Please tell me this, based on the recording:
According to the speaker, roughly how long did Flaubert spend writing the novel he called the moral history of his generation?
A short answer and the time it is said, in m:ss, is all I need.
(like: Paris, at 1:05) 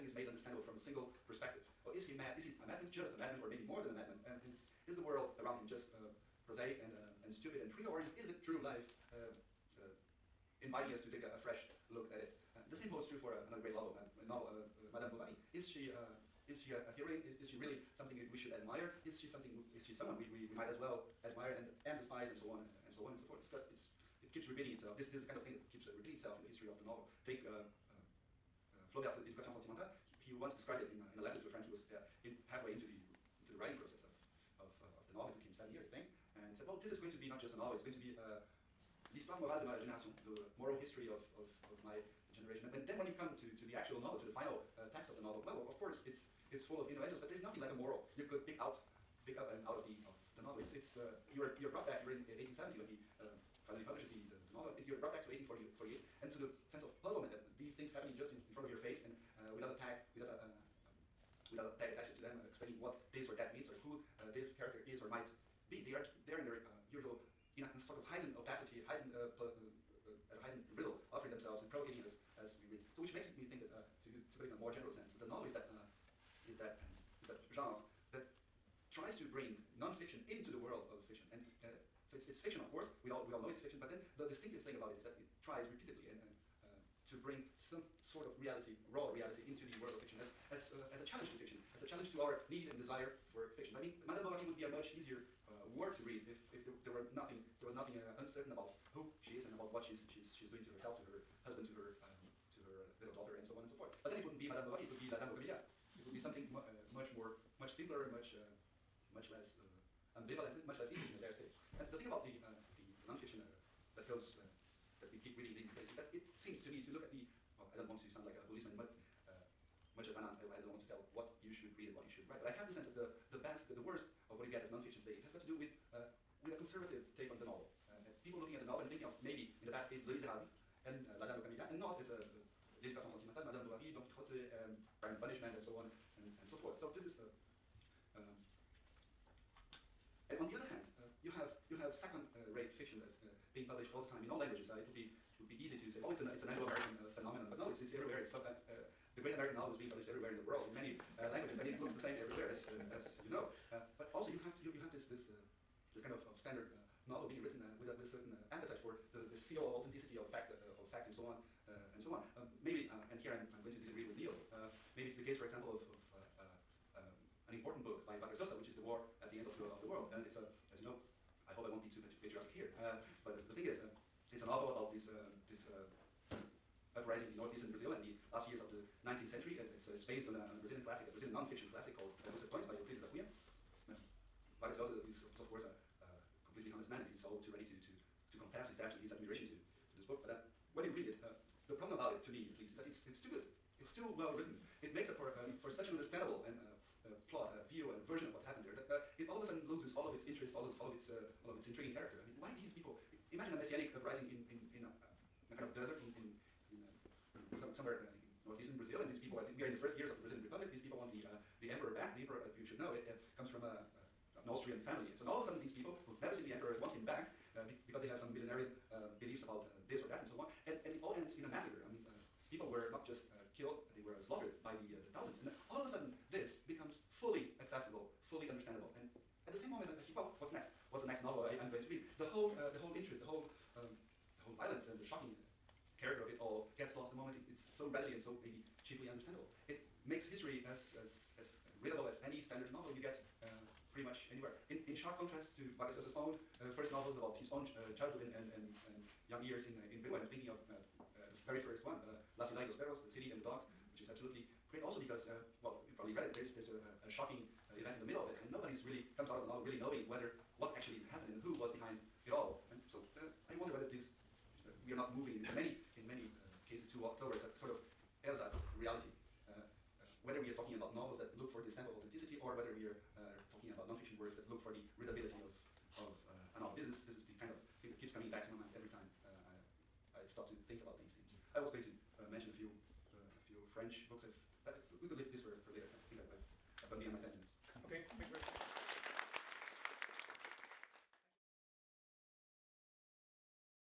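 7 years, at 0:35.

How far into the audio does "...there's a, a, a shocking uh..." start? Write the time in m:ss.
4:16.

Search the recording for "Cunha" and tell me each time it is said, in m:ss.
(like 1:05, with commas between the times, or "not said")
3:03.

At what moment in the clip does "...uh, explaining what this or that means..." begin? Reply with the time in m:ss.
1:02.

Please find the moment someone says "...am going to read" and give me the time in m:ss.
3:51.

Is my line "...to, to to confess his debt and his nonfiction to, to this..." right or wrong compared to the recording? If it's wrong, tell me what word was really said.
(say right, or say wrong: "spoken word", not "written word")
wrong: "admiration", not "nonfiction".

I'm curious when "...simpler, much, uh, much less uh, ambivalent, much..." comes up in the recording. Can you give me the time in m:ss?
1:47.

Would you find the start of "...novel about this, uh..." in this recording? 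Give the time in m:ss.
2:54.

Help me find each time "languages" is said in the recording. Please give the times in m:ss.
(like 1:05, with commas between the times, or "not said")
2:24, 2:31.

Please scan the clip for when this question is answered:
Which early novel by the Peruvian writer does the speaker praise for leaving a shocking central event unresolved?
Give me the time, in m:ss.
4:13.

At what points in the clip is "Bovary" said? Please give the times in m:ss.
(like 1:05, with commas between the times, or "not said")
0:15, 1:34, 1:44, 2:13.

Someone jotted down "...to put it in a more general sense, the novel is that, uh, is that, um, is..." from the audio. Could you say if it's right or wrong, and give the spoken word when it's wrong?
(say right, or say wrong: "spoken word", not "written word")
right.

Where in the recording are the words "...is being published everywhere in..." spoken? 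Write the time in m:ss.
2:29.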